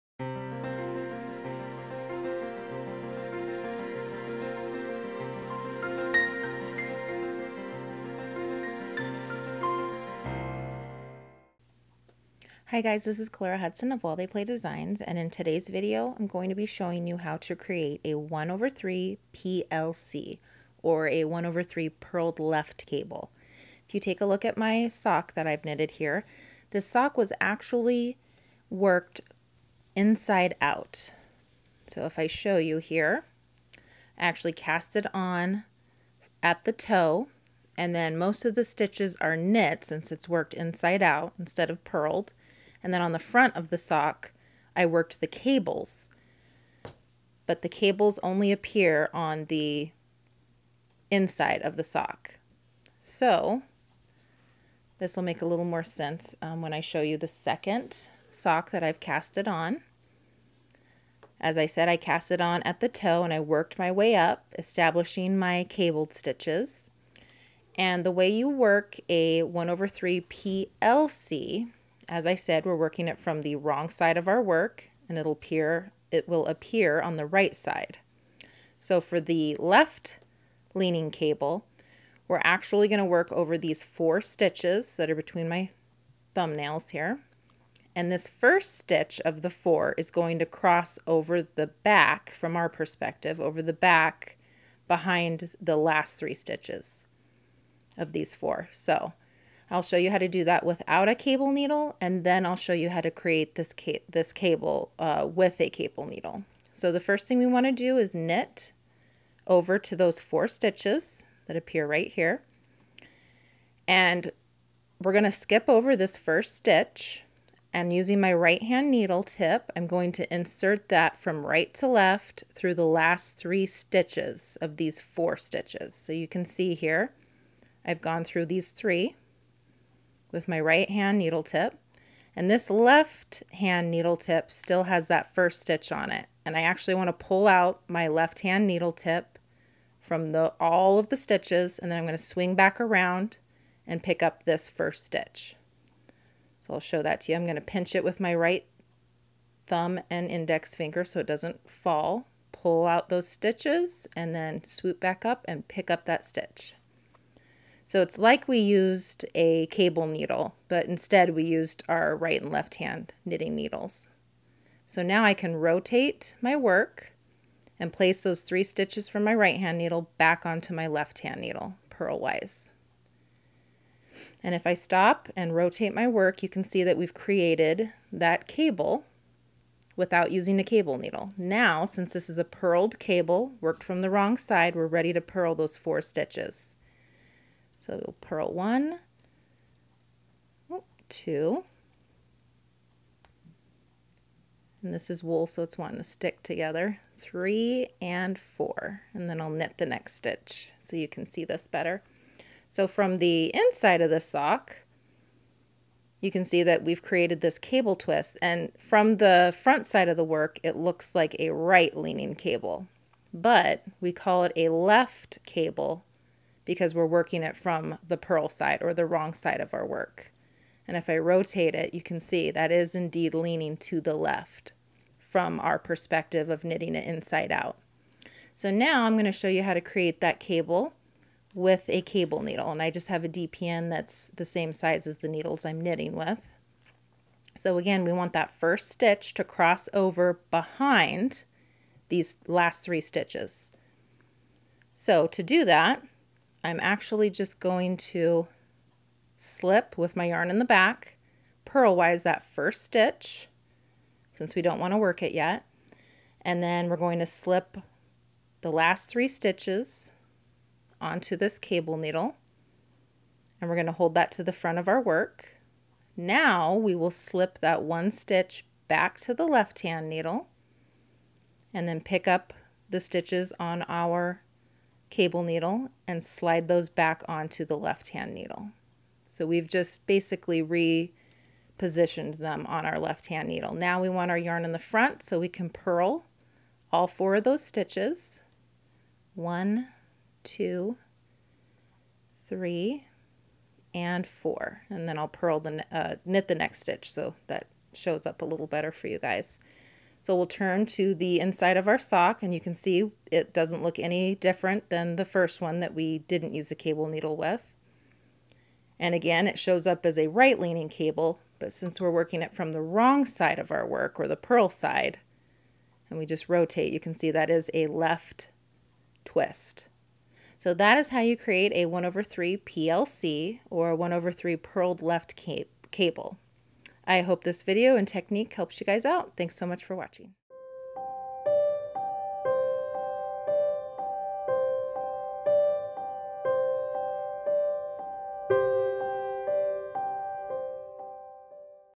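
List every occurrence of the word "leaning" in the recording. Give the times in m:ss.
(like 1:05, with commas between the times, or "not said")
1:20, 3:31, 3:43, 5:10.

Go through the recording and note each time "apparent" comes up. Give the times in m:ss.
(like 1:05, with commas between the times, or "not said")
not said.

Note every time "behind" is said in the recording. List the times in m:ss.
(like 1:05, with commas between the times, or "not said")
1:34, 4:00.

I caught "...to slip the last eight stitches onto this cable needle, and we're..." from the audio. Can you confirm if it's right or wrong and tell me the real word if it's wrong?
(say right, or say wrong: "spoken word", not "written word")
wrong: "three", not "eight".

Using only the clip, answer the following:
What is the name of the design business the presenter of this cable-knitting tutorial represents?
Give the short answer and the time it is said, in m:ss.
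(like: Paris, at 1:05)
While They Play Designs, at 0:14.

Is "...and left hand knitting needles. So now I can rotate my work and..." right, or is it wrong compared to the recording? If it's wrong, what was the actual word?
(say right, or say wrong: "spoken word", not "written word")
right.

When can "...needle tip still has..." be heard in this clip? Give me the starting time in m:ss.
2:13.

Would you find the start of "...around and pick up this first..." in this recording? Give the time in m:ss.
2:22.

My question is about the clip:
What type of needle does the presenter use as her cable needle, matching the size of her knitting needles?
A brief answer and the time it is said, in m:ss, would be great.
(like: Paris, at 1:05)
DPN, at 3:53.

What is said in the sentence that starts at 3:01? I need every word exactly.
Now, since this is a purled cable, worked from the wrong side, we're ready to purl those four stitches.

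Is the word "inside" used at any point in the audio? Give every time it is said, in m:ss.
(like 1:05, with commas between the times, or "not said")
0:29, 0:40, 0:51, 3:23, 3:47, 5:01.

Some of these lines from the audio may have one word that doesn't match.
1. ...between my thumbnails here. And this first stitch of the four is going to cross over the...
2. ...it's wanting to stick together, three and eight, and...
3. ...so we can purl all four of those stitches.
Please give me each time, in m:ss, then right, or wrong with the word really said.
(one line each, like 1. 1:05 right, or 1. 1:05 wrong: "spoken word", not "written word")
1. 1:25 right
2. 3:15 wrong: "four", not "eight"
3. 4:45 right.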